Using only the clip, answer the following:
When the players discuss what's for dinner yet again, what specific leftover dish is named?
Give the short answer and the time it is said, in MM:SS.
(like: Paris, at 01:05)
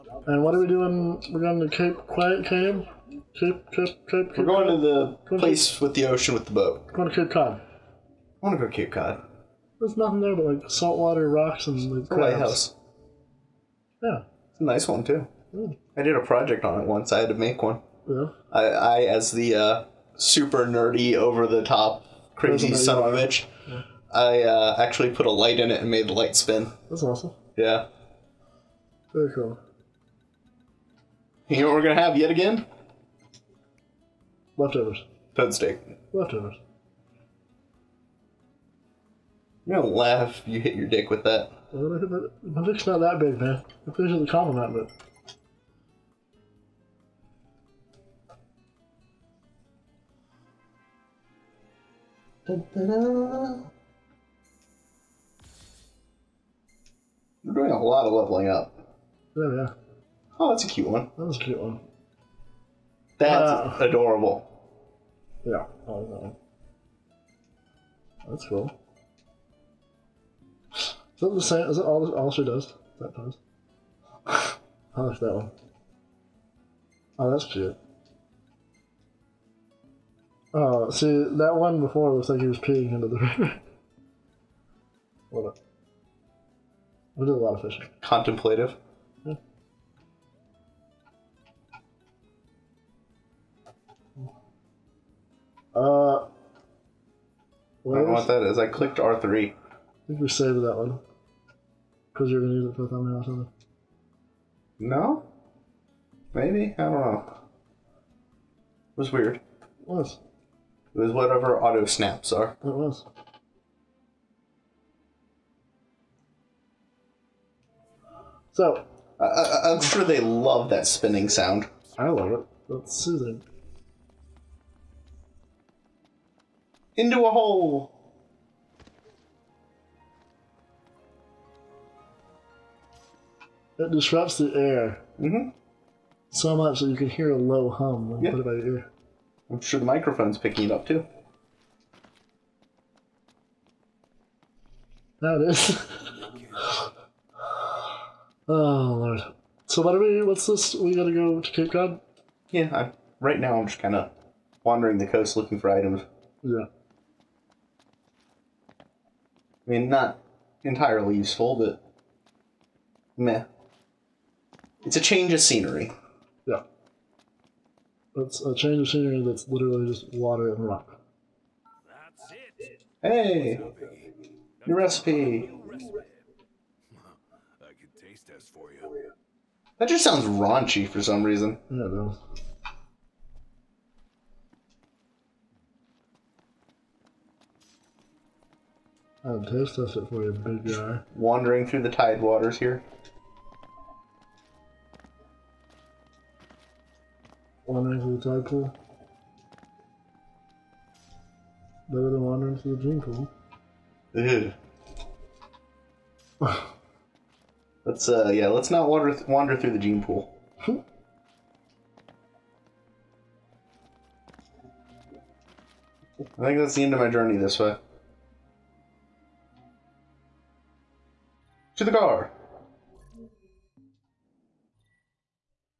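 Toad steak, at 00:35.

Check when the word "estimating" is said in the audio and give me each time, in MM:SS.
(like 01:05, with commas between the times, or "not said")
not said.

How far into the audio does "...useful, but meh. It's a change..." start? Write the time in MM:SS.
02:41.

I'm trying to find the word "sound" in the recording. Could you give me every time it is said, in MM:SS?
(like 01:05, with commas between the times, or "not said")
02:01, 03:00.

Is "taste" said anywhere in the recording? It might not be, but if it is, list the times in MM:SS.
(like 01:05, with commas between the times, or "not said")
02:58, 03:09.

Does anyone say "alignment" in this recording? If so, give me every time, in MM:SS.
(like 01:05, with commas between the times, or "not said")
not said.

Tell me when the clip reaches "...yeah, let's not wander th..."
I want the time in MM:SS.
03:28.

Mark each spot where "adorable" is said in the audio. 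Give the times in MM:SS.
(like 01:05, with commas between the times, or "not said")
01:03.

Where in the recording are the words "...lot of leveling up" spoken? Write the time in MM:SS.
00:57.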